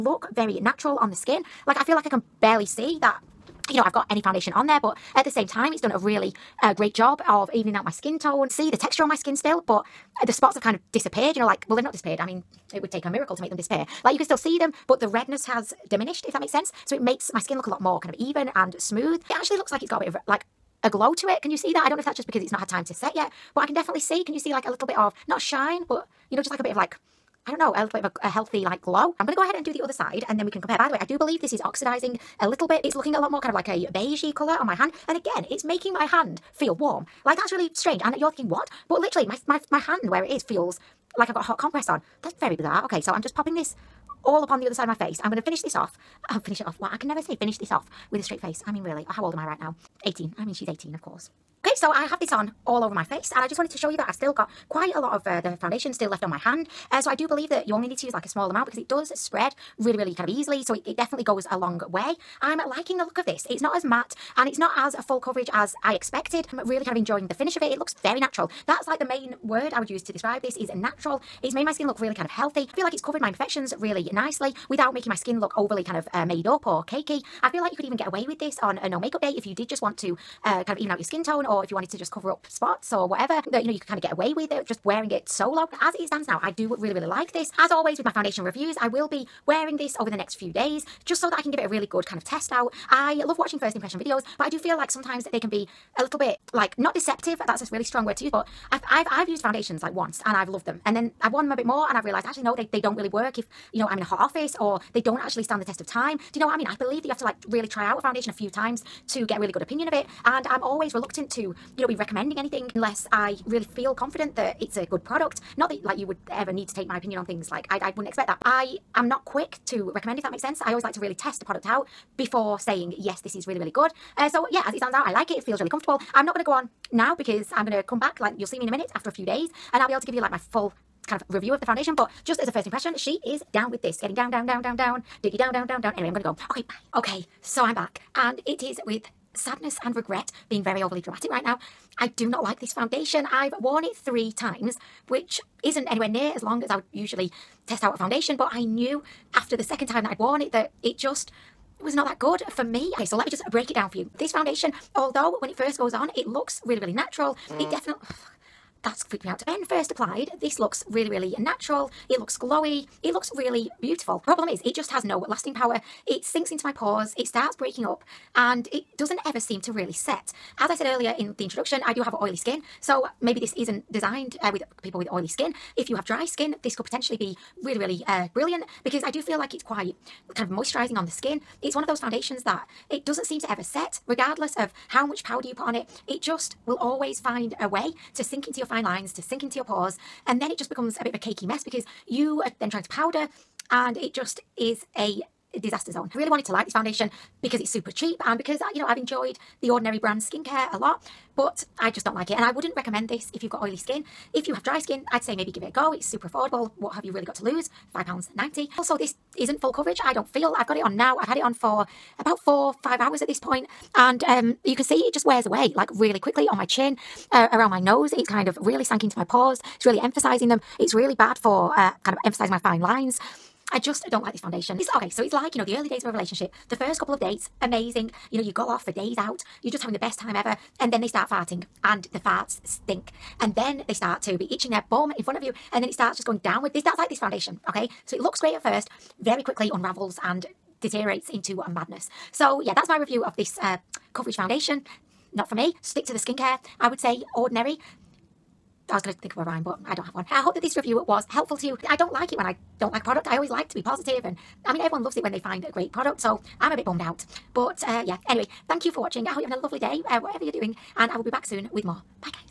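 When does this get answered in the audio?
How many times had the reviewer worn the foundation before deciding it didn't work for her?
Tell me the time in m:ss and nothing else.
2:23.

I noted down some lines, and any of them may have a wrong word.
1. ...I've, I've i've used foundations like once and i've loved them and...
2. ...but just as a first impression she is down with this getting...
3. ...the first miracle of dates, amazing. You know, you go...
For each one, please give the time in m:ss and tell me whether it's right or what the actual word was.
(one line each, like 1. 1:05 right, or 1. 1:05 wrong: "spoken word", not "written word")
1. 1:38 right
2. 2:11 right
3. 3:46 wrong: "couple", not "miracle".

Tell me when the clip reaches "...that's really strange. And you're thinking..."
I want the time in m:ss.
0:37.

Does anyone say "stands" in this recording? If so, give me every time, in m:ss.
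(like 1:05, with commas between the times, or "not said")
1:26, 1:45, 2:04.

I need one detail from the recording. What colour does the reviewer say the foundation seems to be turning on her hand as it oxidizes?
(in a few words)
beigey.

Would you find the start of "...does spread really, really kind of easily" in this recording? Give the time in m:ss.
0:58.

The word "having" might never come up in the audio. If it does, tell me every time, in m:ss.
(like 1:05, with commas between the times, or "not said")
3:49, 4:19.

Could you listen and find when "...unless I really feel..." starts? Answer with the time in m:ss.
1:52.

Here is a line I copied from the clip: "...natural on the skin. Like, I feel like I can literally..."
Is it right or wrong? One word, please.
wrong.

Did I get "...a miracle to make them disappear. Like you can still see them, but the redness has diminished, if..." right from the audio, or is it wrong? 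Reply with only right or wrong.
right.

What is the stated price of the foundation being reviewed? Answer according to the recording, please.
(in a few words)
£5.90.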